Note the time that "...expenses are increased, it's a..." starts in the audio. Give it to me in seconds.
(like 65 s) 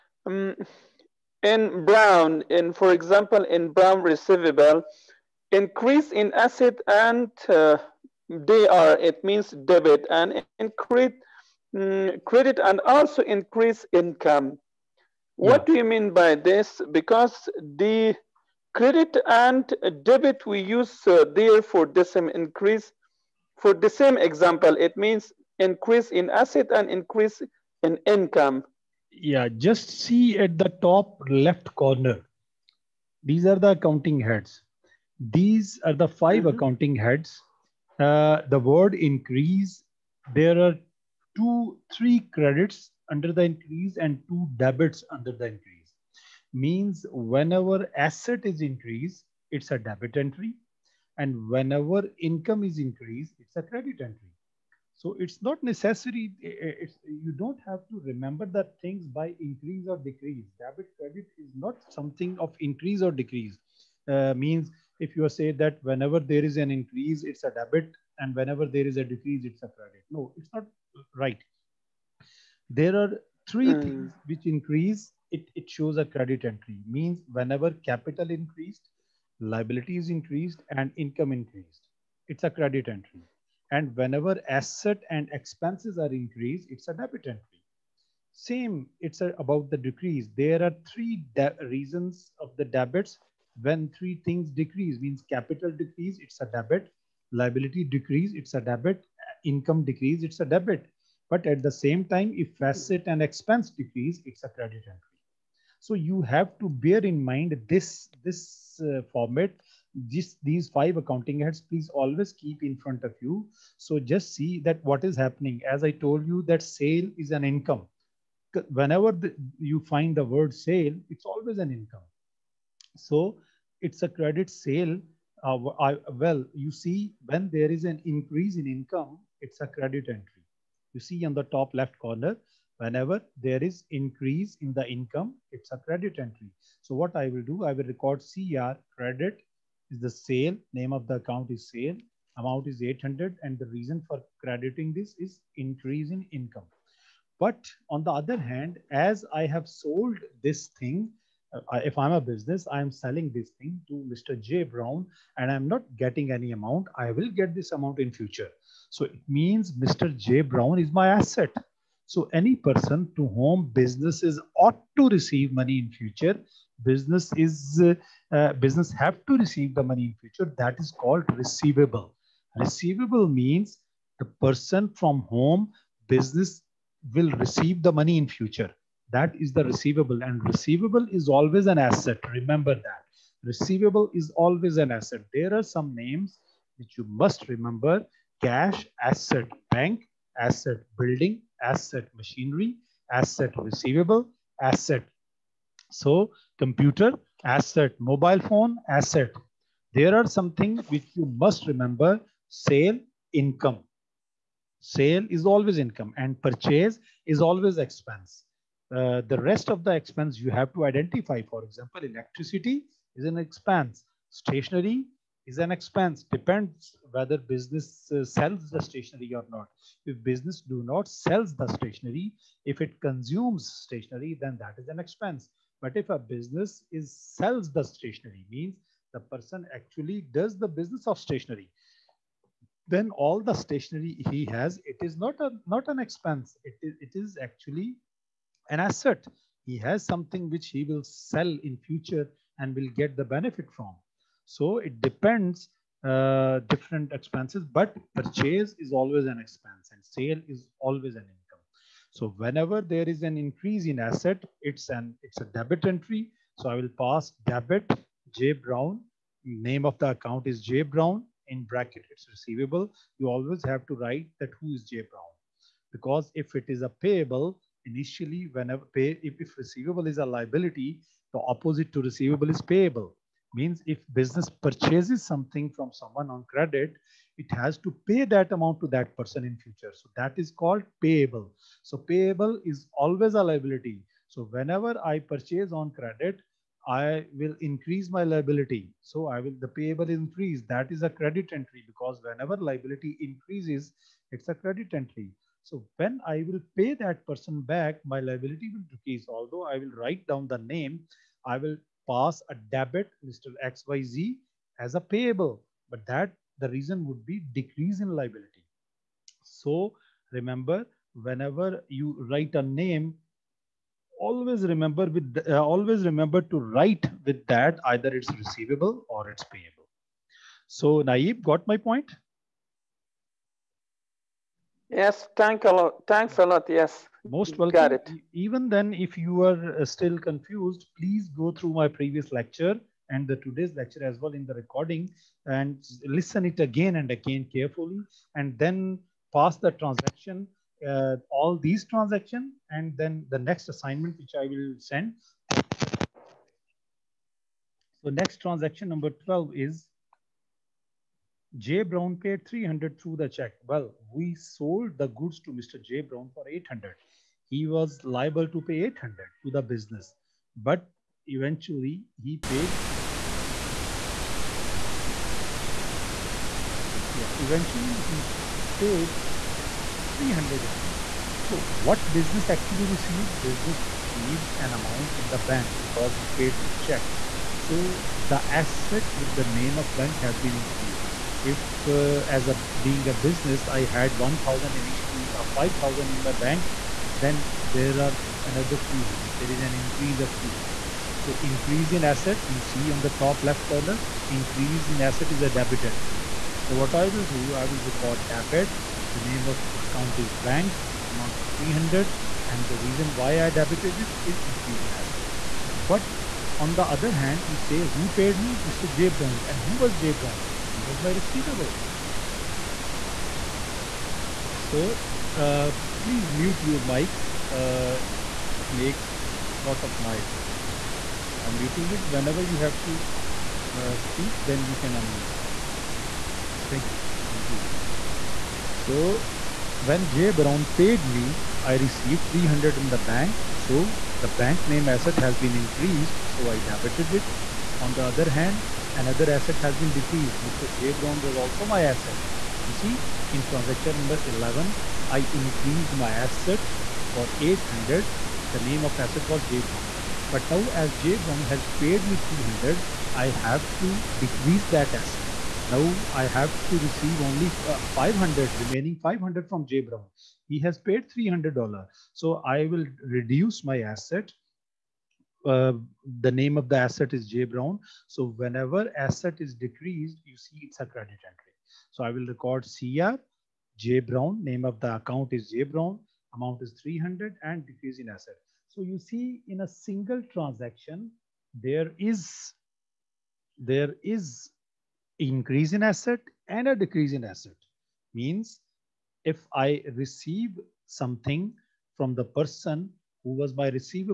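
85 s.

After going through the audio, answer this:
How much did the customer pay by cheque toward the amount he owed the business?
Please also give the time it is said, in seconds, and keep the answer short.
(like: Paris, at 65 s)
300, at 351 s.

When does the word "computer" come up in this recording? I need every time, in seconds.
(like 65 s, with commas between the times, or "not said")
196 s.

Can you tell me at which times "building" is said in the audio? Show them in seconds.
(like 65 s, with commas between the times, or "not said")
190 s.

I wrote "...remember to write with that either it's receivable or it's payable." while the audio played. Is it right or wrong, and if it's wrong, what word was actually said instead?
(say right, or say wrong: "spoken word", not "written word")
right.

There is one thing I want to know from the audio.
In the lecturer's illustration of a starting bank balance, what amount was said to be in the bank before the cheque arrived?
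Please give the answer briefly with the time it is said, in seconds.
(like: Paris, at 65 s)
5,000, at 385 s.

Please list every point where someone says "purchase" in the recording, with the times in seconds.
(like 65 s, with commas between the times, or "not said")
206 s, 248 s, 274 s, 285 s.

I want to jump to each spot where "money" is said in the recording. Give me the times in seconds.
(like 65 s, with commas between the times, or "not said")
165 s, 169 s, 177 s.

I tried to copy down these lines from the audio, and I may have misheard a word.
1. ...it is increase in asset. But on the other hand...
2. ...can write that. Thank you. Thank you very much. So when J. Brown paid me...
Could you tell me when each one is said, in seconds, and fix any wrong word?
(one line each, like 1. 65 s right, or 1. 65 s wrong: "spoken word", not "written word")
1. 403 s right
2. 424 s wrong: "unmute", not "write".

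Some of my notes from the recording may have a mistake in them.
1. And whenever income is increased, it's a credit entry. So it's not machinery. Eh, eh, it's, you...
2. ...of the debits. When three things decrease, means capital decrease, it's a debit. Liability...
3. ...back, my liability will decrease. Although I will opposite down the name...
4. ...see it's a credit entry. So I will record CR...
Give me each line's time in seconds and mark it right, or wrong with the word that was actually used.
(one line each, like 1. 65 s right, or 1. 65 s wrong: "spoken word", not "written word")
1. 51 s wrong: "necessary", not "machinery"
2. 92 s right
3. 297 s wrong: "write", not "opposite"
4. 470 s right.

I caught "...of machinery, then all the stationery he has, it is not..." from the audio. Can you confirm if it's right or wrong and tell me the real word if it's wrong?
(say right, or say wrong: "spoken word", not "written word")
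wrong: "stationery", not "machinery".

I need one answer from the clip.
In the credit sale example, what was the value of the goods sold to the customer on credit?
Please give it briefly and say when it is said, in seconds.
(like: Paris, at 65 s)
800, at 142 s.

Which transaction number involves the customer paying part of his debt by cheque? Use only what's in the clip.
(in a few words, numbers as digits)
12.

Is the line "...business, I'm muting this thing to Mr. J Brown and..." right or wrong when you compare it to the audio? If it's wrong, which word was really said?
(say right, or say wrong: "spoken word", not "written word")
wrong: "selling", not "muting".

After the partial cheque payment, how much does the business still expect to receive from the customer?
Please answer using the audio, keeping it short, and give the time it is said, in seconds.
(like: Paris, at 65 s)
500, at 458 s.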